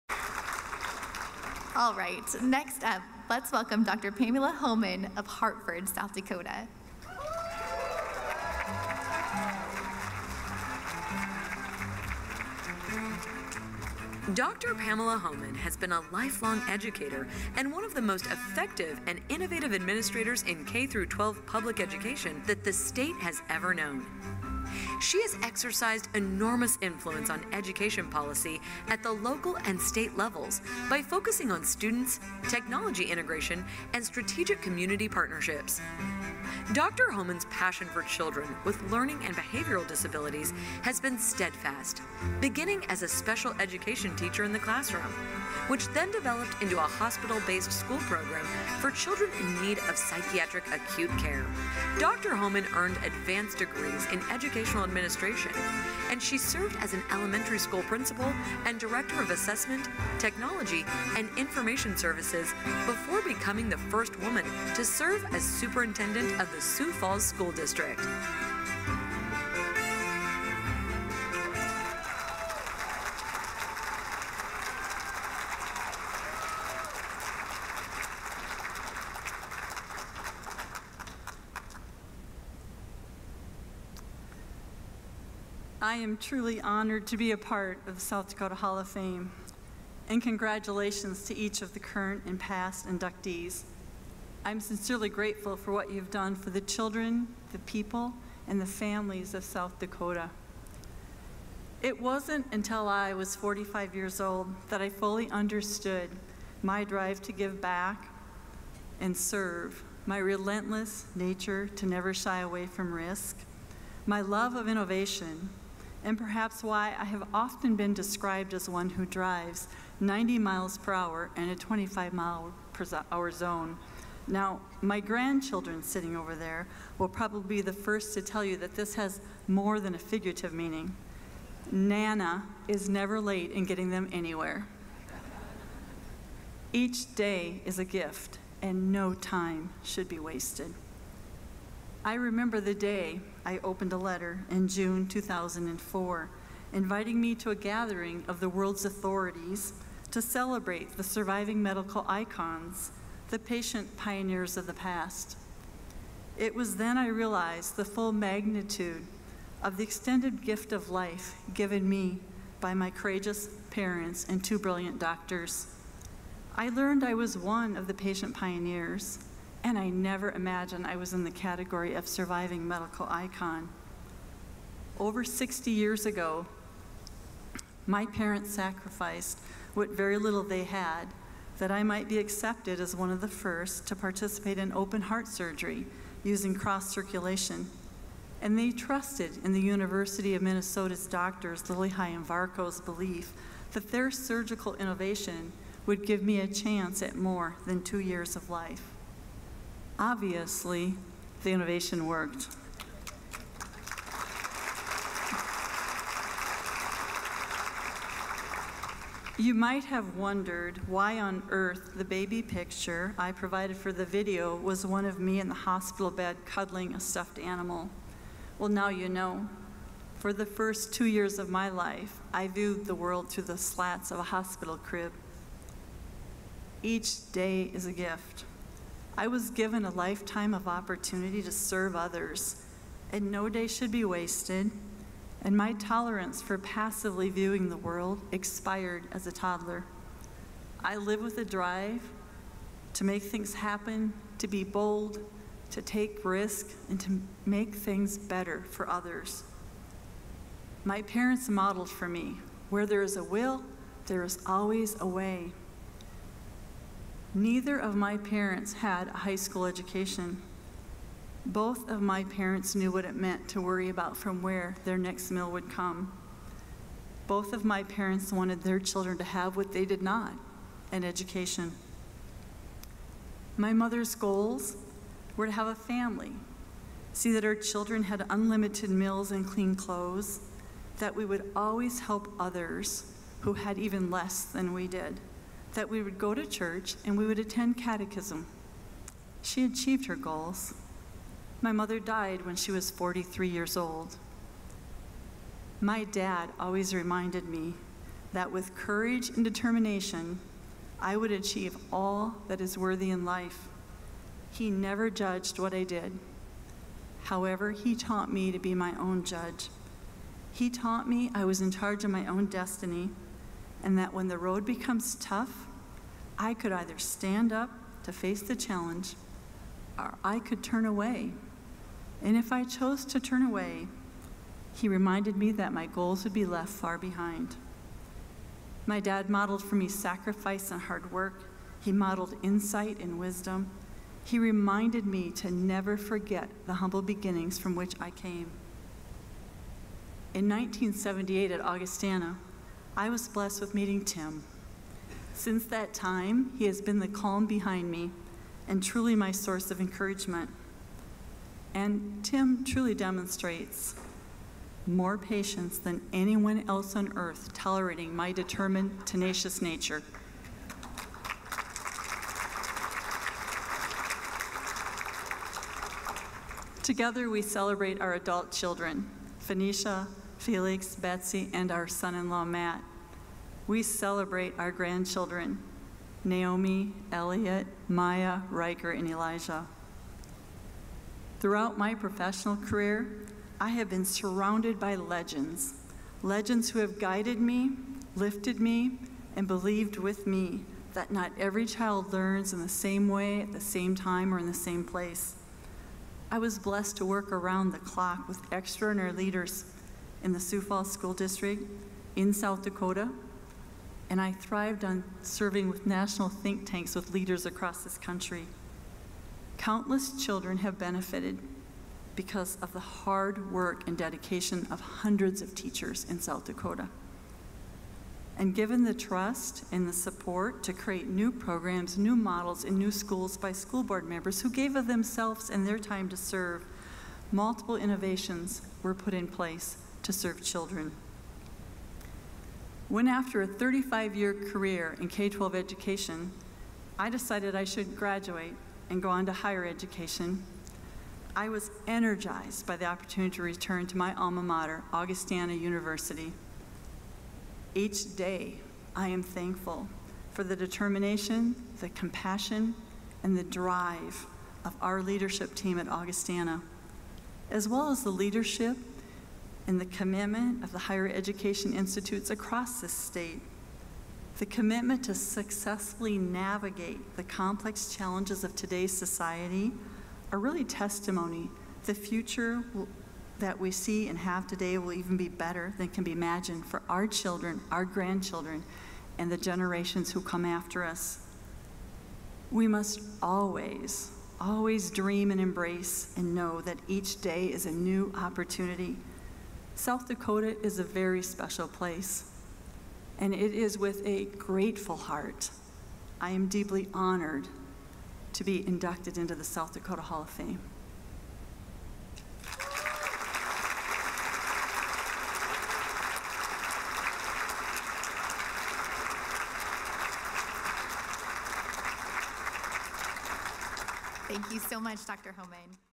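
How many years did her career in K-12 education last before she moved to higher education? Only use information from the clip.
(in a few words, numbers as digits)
35.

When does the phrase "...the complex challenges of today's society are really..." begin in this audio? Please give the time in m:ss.
7:47.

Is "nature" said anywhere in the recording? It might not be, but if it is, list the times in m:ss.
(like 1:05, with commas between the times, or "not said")
1:51, 5:59.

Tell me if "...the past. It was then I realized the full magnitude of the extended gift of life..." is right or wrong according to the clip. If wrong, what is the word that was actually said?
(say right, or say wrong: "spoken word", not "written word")
right.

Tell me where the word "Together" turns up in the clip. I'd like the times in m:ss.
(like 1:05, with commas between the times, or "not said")
6:06.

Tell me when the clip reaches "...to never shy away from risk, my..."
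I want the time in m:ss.
1:51.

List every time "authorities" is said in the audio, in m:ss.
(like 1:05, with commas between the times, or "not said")
2:28.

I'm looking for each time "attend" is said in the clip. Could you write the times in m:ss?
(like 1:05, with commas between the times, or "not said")
4:47.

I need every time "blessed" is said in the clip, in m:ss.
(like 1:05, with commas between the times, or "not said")
5:43, 6:36.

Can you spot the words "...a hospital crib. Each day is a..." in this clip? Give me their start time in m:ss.
3:44.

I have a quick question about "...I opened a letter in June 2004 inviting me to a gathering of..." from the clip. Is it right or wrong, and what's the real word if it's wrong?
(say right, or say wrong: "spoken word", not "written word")
right.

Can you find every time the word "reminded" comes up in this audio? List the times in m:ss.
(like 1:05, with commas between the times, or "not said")
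4:56, 5:24, 5:34.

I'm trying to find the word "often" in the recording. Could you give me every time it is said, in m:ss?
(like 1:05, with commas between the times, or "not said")
1:57.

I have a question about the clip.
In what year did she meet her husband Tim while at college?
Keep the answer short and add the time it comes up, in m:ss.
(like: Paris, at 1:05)
1978, at 5:40.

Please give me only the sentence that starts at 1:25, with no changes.
I am truly honored to be a part of South Dakota Hall of Fame.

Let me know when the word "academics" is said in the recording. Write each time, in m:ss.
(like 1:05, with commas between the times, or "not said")
not said.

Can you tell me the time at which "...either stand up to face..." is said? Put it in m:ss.
5:16.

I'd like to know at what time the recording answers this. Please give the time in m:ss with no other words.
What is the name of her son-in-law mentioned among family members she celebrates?
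6:12.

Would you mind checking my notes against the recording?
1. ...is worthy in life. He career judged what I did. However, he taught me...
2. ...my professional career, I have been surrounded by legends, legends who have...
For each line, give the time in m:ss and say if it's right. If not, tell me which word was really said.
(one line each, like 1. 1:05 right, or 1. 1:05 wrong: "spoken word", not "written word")
1. 5:02 wrong: "never", not "career"
2. 6:21 right.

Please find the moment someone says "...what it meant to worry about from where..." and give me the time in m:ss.
4:22.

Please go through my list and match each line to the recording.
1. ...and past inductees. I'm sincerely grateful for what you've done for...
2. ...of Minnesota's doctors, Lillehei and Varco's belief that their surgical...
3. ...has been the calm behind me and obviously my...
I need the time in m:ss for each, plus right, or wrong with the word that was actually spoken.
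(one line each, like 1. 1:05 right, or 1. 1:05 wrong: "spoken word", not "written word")
1. 1:32 right
2. 3:10 right
3. 5:46 wrong: "truly", not "obviously".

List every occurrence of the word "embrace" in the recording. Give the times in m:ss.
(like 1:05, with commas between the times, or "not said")
8:05.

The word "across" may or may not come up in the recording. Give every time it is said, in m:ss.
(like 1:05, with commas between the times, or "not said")
6:47, 7:42.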